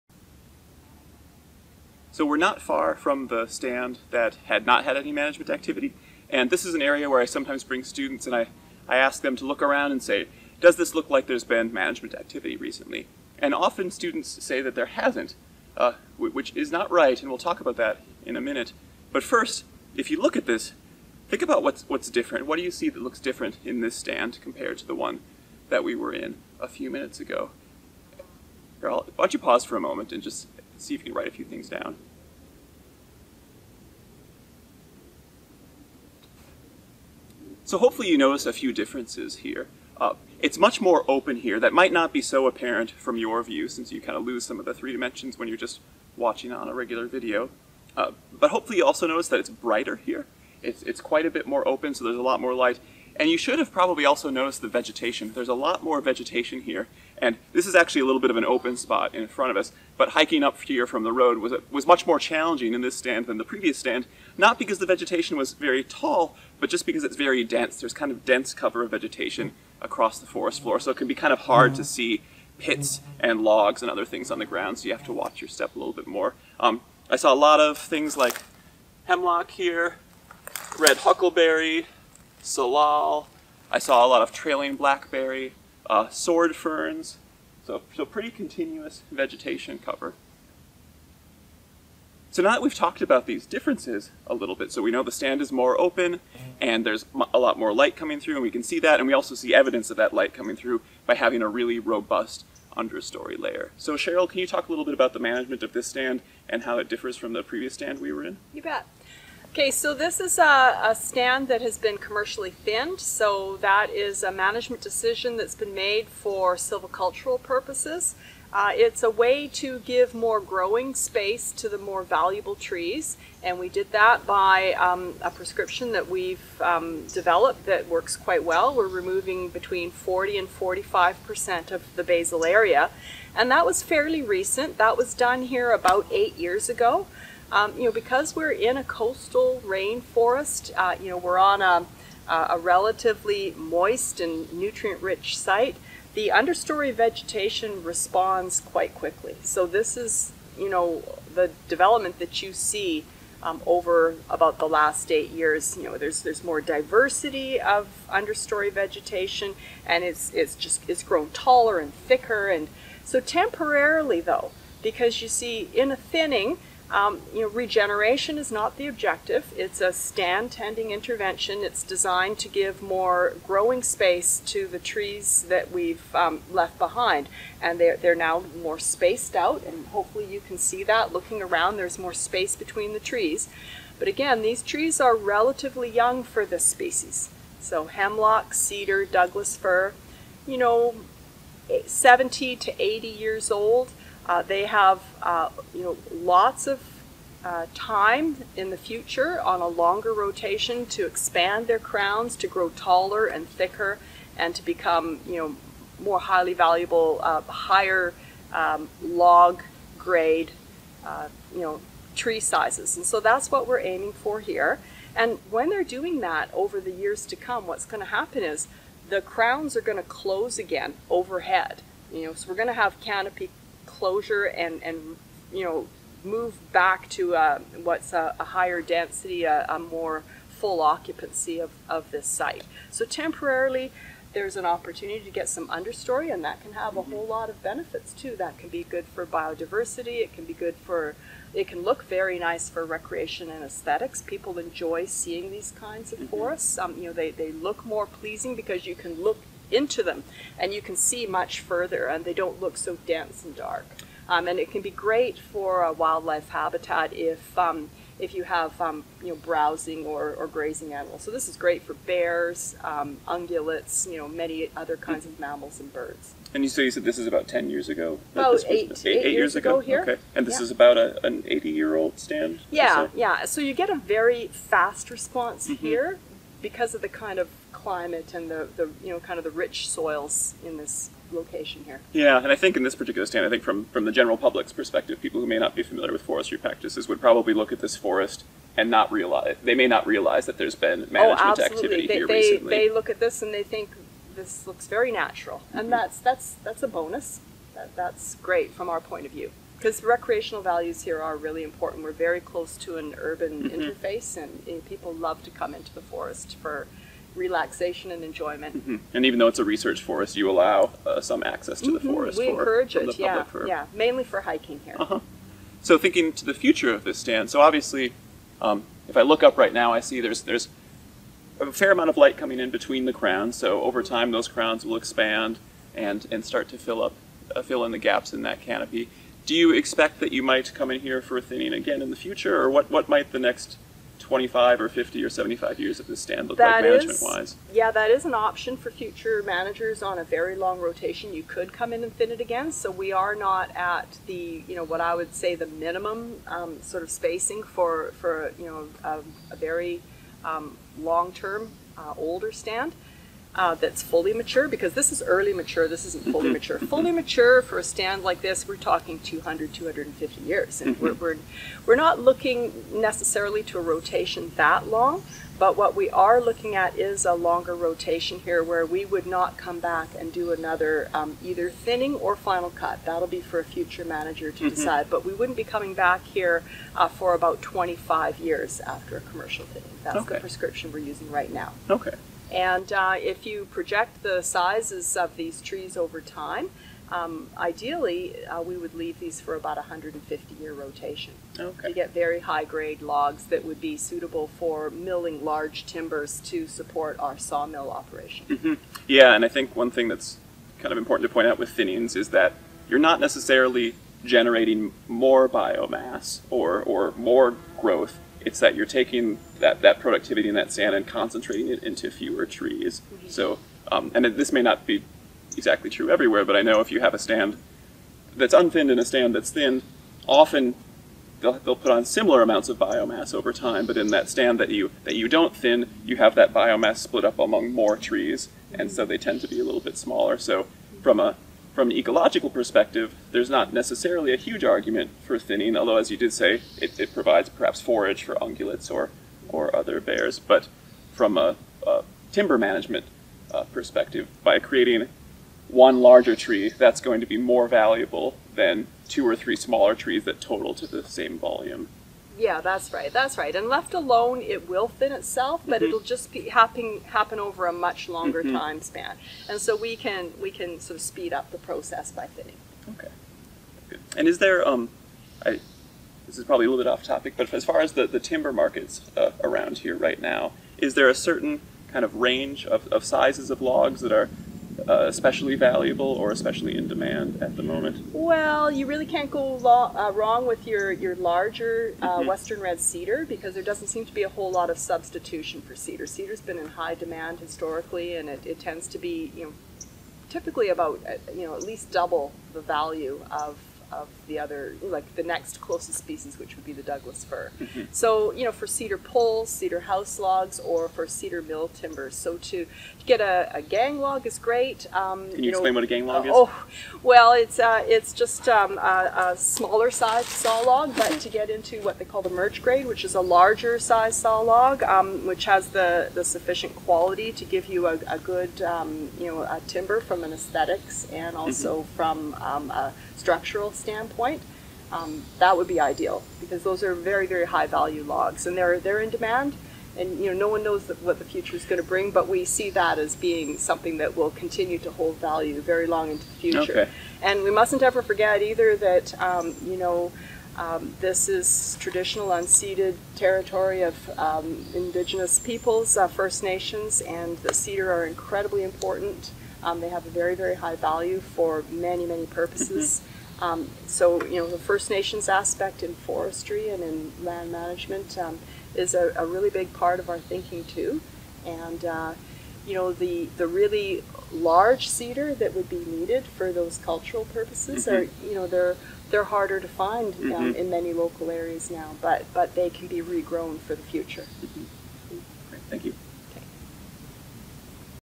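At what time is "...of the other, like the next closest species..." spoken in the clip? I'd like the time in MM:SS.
08:13.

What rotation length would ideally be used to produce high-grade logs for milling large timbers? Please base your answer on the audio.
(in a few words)
150 years.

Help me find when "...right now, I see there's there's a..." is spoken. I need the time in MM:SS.
05:19.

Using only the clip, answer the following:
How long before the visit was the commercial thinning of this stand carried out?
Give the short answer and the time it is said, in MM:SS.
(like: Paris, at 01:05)
8 years, at 02:15.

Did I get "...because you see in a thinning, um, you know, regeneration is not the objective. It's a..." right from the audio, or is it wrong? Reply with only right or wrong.
right.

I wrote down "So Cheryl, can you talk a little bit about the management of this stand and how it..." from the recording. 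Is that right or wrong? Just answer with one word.
right.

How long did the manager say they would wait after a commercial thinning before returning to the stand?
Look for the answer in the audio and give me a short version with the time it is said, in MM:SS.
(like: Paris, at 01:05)
25 years, at 06:17.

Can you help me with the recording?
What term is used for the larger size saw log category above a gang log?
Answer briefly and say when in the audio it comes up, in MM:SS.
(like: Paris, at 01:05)
merge grade, at 08:32.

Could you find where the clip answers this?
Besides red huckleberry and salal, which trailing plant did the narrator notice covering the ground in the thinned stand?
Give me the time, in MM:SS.
01:24.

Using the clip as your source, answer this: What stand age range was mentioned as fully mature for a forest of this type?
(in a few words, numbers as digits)
200 to 250 years.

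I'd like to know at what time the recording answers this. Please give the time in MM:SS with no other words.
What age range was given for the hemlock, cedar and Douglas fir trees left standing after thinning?
03:11.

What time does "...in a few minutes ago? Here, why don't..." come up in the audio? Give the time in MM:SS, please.
00:26.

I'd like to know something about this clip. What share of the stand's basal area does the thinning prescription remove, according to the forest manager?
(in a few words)
40 to 45 percent.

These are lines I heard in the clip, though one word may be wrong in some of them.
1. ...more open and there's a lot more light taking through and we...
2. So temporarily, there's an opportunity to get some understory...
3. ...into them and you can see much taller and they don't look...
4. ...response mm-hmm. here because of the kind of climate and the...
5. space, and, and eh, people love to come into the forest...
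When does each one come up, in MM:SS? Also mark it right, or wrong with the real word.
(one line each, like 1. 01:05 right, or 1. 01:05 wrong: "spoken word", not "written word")
1. 01:35 wrong: "coming", not "taking"
2. 03:52 right
3. 04:09 wrong: "further", not "taller"
4. 04:35 right
5. 05:03 wrong: "interface", not "space".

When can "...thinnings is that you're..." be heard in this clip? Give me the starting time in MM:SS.
06:41.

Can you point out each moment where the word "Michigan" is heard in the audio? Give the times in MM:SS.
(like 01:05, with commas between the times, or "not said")
not said.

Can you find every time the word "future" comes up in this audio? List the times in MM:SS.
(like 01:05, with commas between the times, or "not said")
03:18, 05:16, 05:32, 05:38, 06:13, 08:51, 08:56, 09:33.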